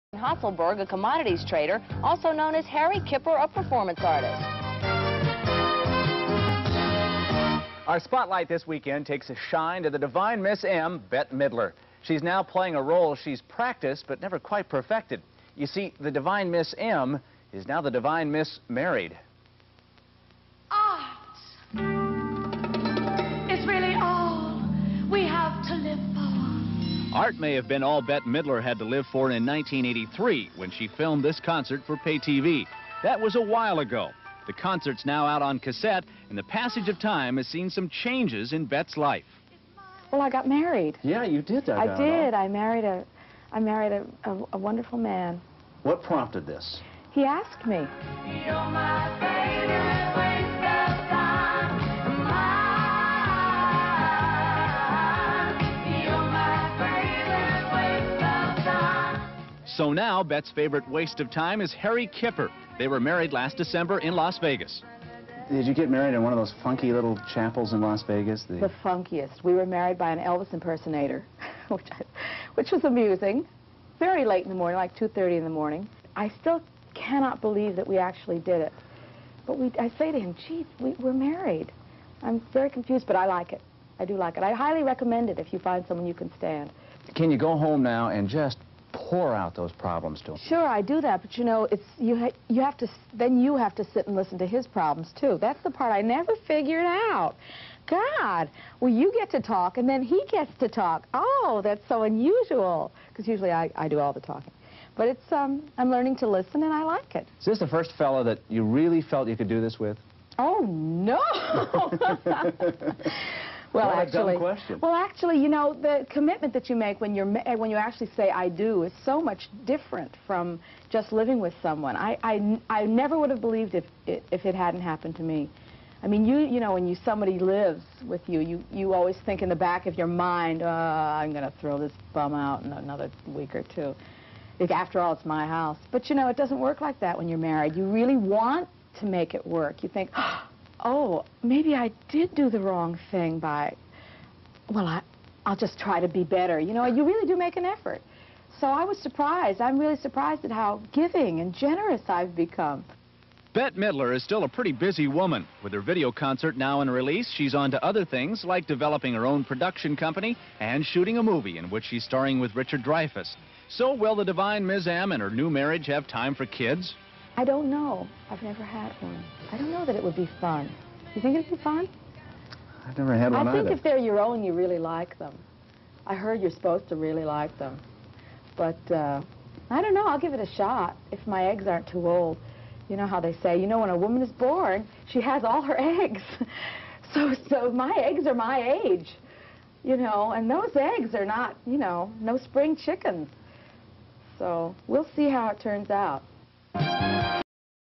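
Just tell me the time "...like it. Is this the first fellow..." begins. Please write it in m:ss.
1:46.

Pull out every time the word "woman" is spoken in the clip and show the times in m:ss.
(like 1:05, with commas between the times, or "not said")
2:35, 3:03.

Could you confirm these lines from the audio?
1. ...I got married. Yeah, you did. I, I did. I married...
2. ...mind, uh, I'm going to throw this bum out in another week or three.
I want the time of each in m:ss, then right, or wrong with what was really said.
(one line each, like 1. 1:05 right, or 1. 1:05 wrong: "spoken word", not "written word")
1. 0:40 right
2. 2:10 wrong: "two", not "three".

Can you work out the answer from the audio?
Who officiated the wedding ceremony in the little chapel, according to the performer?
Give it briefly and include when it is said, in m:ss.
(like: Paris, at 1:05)
An Elvis impersonator, at 1:10.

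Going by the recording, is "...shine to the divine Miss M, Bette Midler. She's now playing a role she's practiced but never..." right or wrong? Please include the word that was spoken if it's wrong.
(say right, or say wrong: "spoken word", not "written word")
right.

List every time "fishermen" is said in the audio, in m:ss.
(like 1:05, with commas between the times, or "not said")
not said.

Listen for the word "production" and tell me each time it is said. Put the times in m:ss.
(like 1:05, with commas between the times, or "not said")
2:39.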